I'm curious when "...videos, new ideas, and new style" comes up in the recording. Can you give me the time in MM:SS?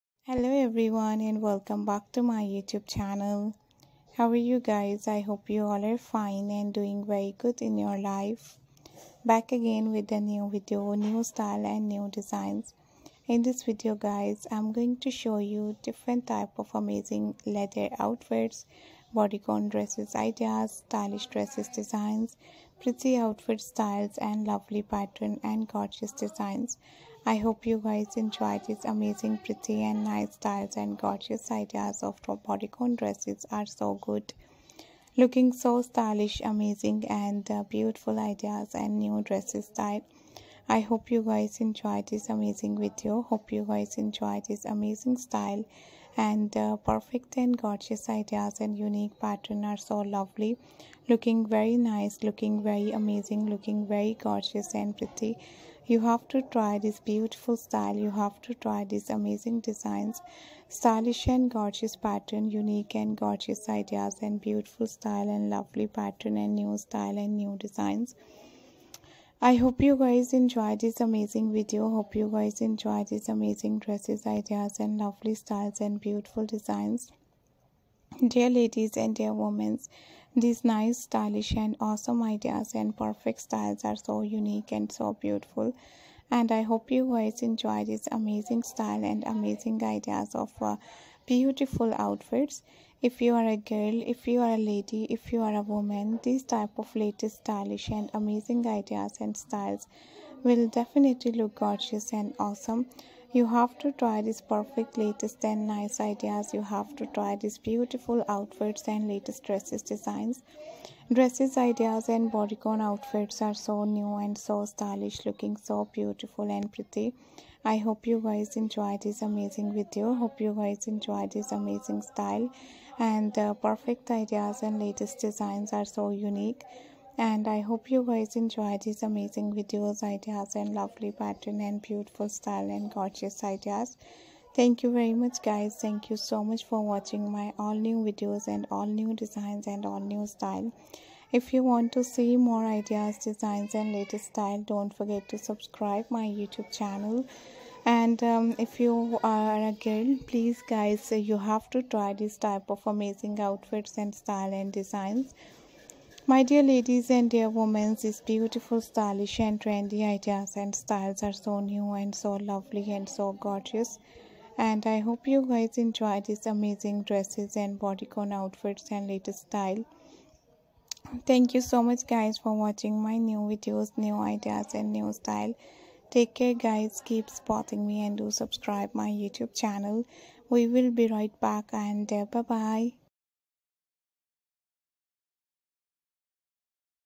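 02:53.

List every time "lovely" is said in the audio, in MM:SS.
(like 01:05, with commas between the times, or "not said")
00:24, 00:50, 01:05, 01:14, 02:10, 02:42.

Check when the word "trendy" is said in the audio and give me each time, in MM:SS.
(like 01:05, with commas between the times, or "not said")
02:39.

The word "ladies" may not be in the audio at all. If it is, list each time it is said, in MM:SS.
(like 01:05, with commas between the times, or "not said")
01:18, 02:36.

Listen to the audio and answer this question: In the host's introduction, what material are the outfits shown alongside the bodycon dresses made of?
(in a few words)
leather.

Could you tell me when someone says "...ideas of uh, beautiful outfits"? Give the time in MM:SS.
01:29.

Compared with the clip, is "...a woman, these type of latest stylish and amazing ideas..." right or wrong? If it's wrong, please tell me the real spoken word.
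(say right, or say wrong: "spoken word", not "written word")
right.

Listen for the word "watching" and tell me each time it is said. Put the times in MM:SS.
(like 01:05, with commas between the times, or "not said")
02:16, 02:52.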